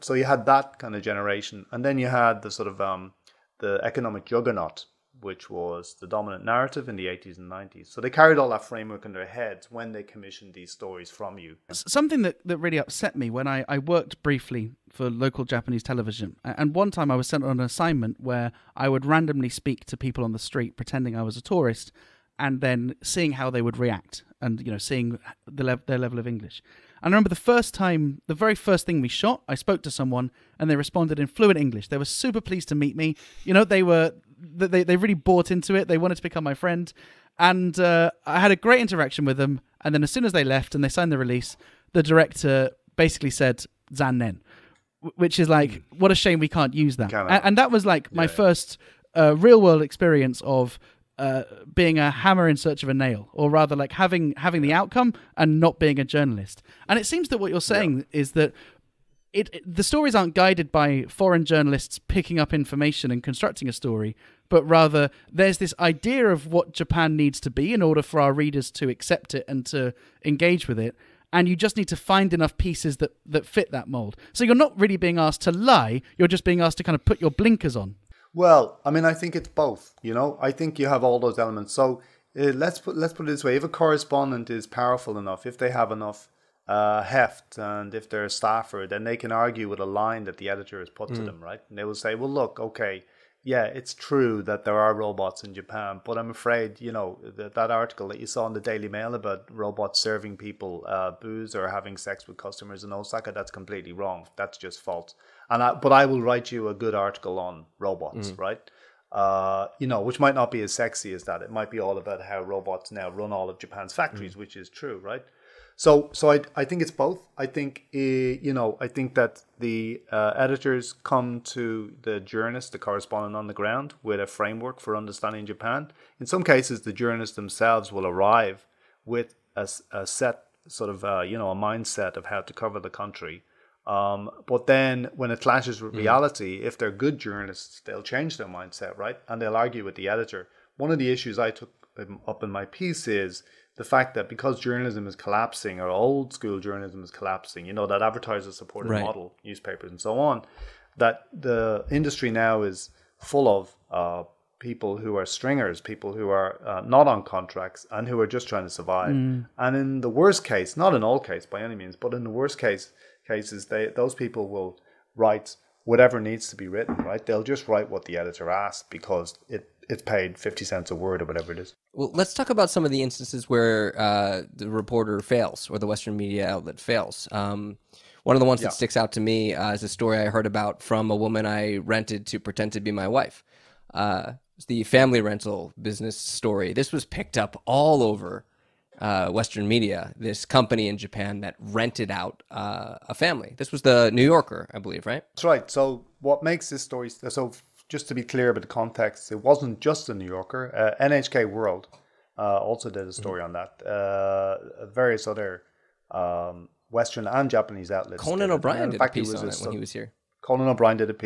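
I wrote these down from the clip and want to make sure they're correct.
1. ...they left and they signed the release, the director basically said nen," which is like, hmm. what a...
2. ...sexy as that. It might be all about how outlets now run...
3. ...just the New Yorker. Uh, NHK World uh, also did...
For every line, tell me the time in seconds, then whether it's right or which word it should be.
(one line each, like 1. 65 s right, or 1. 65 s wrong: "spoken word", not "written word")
1. 40 s right
2. 110 s wrong: "robots", not "outlets"
3. 199 s right.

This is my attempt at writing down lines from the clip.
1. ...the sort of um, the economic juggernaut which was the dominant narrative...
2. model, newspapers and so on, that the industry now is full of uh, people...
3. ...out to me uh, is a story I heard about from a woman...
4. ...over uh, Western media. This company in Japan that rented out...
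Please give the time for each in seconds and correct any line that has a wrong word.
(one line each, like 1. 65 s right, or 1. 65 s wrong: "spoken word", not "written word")
1. 2 s right
2. 149 s right
3. 178 s right
4. 188 s right.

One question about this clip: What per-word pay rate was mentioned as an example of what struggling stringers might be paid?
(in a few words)
50 cents a word.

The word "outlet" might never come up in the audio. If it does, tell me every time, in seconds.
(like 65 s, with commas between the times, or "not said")
176 s, 207 s.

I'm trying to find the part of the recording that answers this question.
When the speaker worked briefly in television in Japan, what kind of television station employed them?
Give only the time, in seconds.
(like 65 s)
15 s.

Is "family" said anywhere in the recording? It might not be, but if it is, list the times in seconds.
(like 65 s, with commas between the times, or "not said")
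184 s, 193 s.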